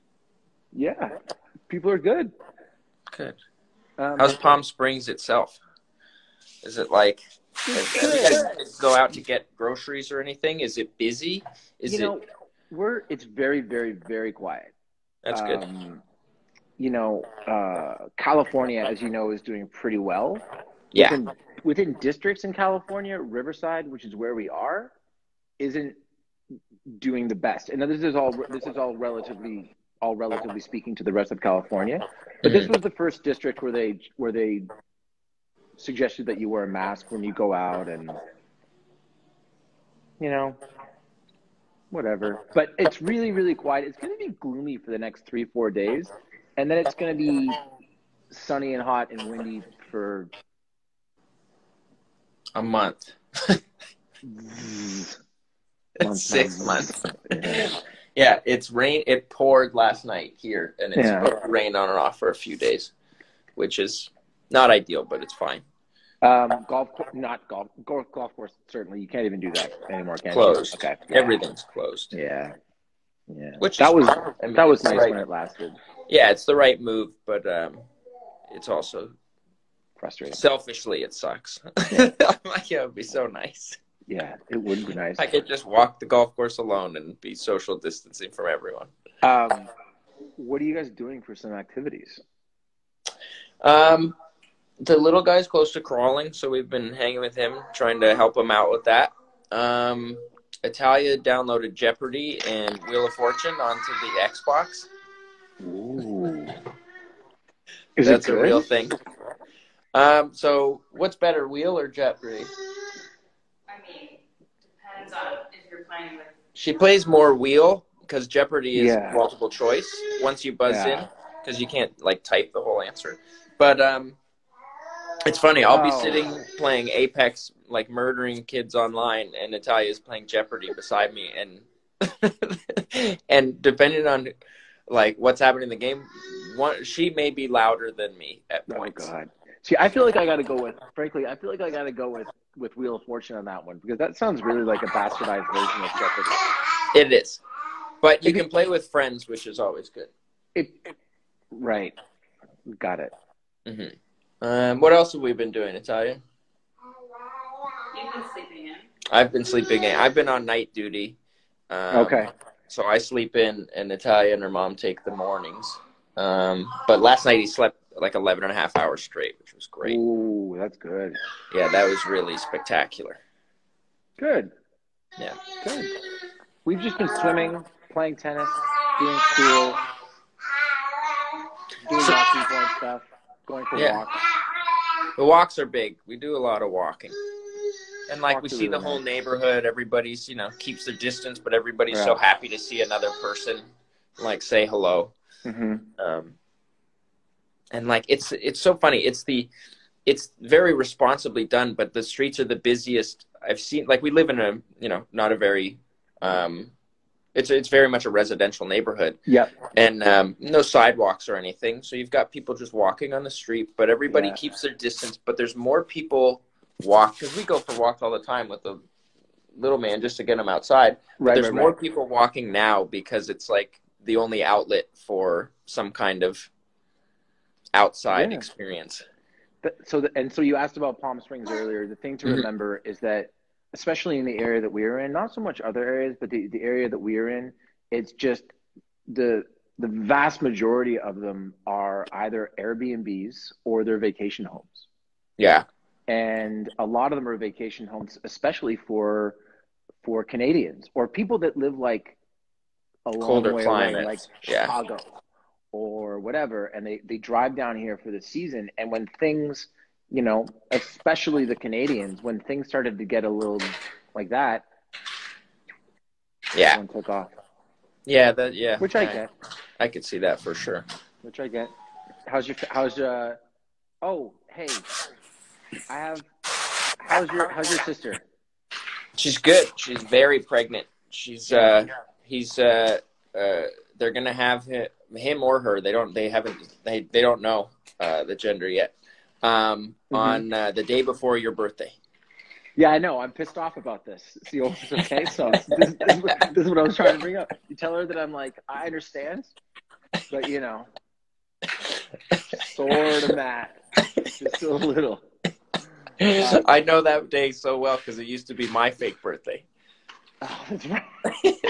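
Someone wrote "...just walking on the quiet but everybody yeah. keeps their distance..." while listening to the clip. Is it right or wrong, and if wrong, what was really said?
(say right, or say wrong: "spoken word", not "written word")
wrong: "street", not "quiet".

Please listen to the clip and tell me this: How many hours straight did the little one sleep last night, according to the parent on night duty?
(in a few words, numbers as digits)
11 and a half.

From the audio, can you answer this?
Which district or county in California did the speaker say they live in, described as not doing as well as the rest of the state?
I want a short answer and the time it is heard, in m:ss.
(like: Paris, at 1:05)
Riverside, at 0:23.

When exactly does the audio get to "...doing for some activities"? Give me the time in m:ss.
1:30.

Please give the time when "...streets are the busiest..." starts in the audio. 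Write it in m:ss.
3:22.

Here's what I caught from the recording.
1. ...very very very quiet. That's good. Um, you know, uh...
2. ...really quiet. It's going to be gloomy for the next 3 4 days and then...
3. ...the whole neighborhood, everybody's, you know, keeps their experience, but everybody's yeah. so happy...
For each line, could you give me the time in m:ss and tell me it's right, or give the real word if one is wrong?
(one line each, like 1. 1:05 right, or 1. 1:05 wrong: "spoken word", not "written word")
1. 0:13 right
2. 0:43 right
3. 3:08 wrong: "distance", not "experience".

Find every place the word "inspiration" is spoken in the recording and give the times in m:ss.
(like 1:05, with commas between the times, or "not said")
not said.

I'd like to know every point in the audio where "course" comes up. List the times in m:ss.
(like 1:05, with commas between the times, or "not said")
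1:08, 1:26.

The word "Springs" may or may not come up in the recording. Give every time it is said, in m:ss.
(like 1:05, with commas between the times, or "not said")
0:04, 3:51.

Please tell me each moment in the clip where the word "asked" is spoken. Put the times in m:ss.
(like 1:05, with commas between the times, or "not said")
3:50.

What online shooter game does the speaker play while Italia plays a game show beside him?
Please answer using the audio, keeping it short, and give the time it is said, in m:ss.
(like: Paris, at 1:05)
Apex, at 2:06.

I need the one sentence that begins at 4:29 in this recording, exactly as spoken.
I could see that for sure.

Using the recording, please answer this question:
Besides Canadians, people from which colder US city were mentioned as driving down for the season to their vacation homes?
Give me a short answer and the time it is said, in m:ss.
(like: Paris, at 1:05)
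Chicago, at 4:14.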